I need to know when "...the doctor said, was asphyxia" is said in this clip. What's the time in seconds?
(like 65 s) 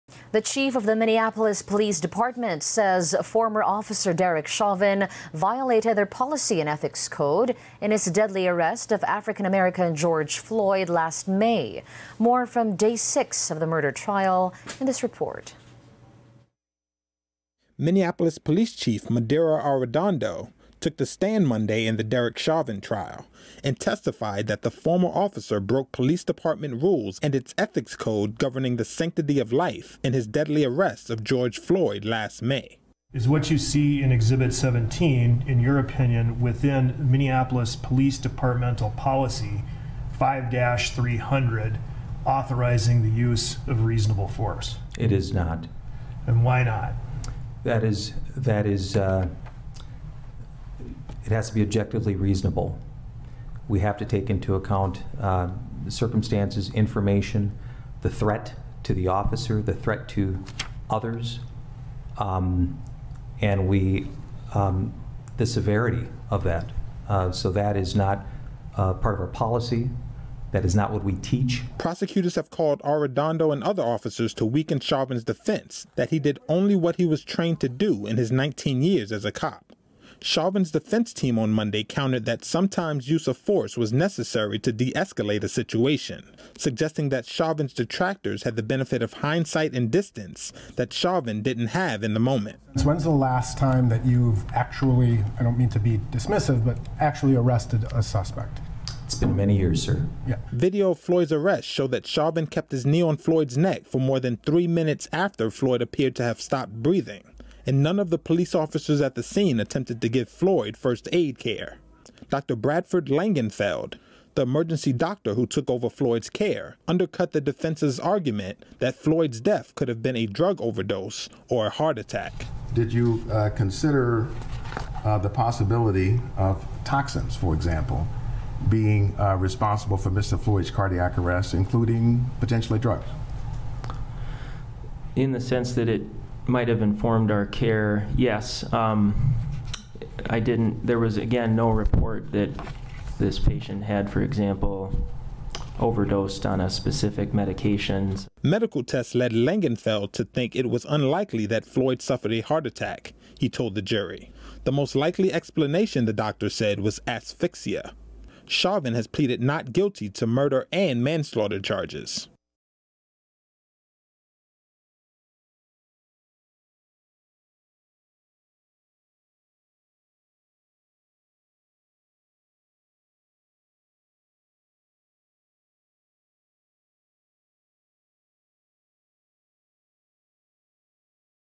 156 s.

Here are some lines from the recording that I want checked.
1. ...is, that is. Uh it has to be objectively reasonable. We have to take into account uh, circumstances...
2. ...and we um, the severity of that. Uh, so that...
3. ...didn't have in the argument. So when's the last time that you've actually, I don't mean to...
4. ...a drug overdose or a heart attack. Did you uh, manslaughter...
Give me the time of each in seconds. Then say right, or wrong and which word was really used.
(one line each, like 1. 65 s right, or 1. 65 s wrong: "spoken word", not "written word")
1. 47 s right
2. 63 s right
3. 91 s wrong: "moment", not "argument"
4. 120 s wrong: "consider", not "manslaughter".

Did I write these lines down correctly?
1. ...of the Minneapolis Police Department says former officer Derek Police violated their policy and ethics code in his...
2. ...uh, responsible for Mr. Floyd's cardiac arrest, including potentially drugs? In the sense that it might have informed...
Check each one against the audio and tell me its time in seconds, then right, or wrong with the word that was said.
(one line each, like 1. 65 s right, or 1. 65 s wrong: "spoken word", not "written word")
1. 0 s wrong: "Chauvin", not "Police"
2. 129 s right.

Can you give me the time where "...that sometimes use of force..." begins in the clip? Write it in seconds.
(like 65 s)
82 s.